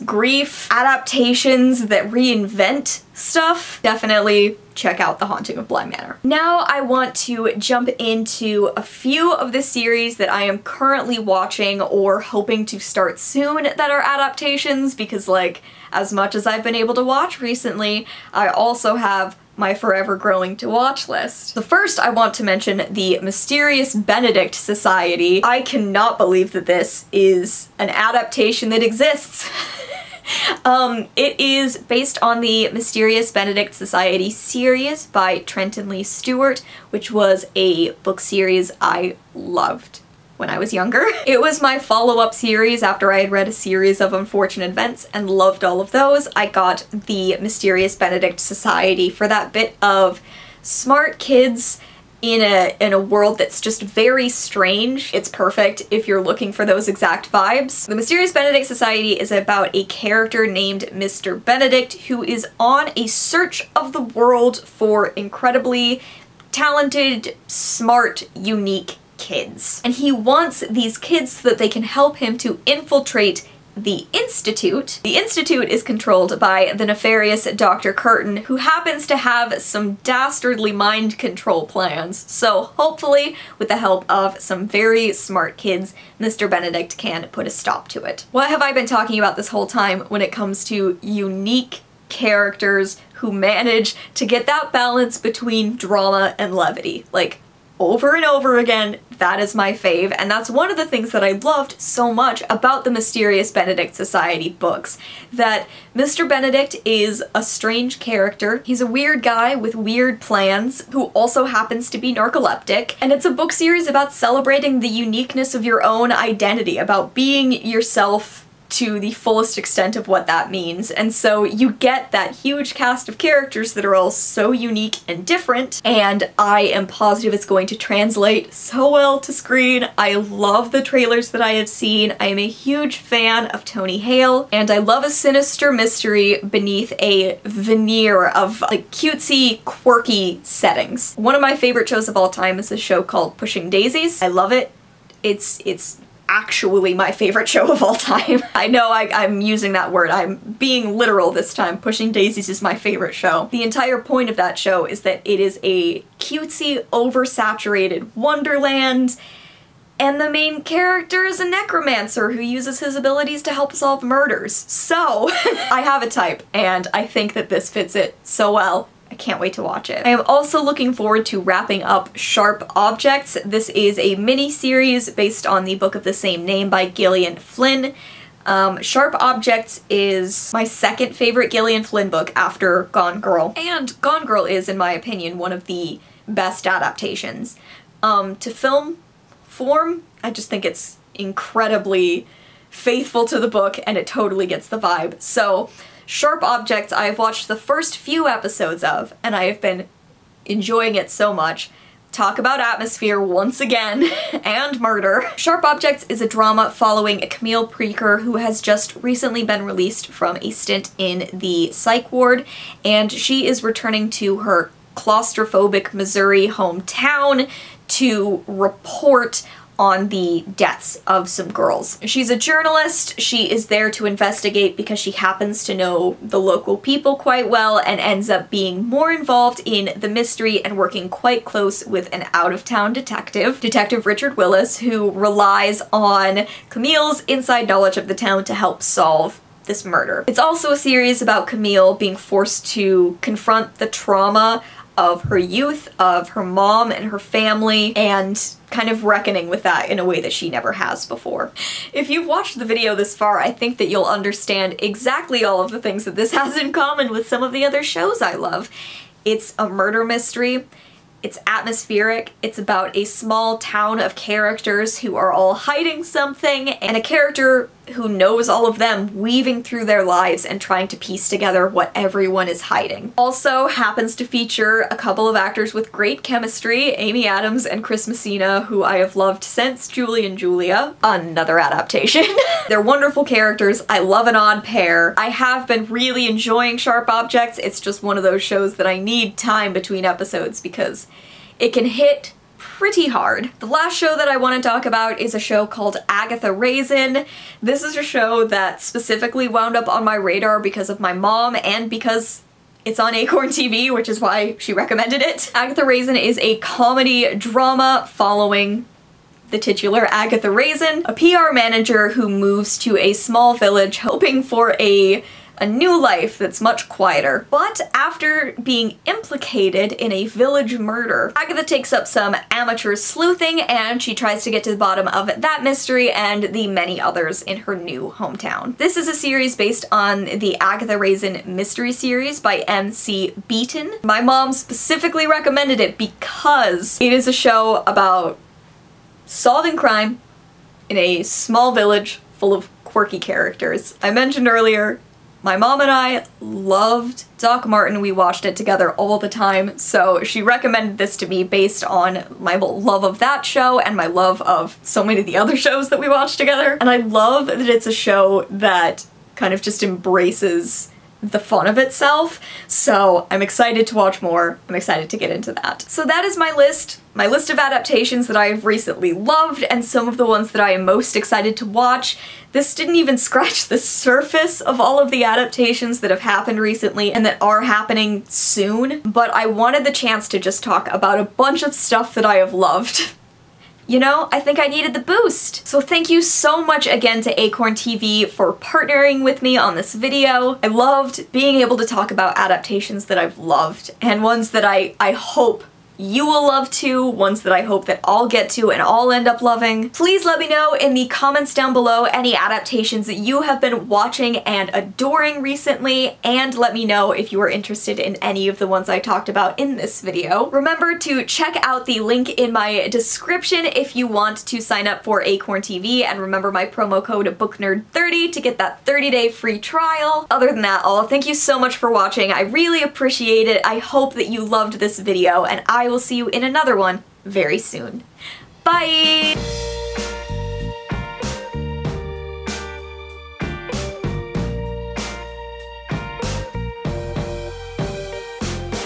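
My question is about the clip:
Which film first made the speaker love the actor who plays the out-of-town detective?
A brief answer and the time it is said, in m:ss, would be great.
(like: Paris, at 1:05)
Julie and Julia, at 4:39.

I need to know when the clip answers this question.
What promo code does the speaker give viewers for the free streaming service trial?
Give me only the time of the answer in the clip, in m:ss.
6:57.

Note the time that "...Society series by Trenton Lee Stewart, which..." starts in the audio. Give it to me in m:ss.
0:33.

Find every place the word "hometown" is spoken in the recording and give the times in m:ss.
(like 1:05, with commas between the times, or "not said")
3:36, 5:28.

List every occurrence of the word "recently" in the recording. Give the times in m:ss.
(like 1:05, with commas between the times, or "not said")
0:17, 3:28, 6:08, 6:16, 6:45.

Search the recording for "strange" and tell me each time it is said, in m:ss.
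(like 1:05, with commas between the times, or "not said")
0:54, 1:47.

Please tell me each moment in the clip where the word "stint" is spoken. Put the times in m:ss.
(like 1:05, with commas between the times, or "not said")
3:30.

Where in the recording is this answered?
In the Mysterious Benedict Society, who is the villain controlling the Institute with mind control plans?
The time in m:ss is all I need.
1:17.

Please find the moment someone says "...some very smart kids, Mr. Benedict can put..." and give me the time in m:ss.
1:24.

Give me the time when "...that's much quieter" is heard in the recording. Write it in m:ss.
5:16.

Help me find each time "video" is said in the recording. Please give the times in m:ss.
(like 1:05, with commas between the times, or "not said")
4:12, 6:29, 6:49, 7:04.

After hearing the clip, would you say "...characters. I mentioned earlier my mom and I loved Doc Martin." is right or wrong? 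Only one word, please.
right.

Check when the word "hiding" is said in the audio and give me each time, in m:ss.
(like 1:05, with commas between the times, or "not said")
4:25, 4:32.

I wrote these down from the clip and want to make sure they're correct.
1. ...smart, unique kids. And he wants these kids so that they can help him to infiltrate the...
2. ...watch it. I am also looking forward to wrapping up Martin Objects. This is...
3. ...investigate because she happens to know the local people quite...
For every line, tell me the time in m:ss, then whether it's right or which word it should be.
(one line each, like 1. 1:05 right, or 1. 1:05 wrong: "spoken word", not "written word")
1. 1:07 right
2. 2:49 wrong: "Sharp", not "Martin"
3. 3:44 right.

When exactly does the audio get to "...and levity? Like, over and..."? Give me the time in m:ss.
1:36.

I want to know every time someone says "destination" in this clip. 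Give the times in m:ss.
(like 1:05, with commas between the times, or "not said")
not said.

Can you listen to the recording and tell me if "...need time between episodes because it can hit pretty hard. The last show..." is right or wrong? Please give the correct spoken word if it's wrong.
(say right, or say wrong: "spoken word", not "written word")
right.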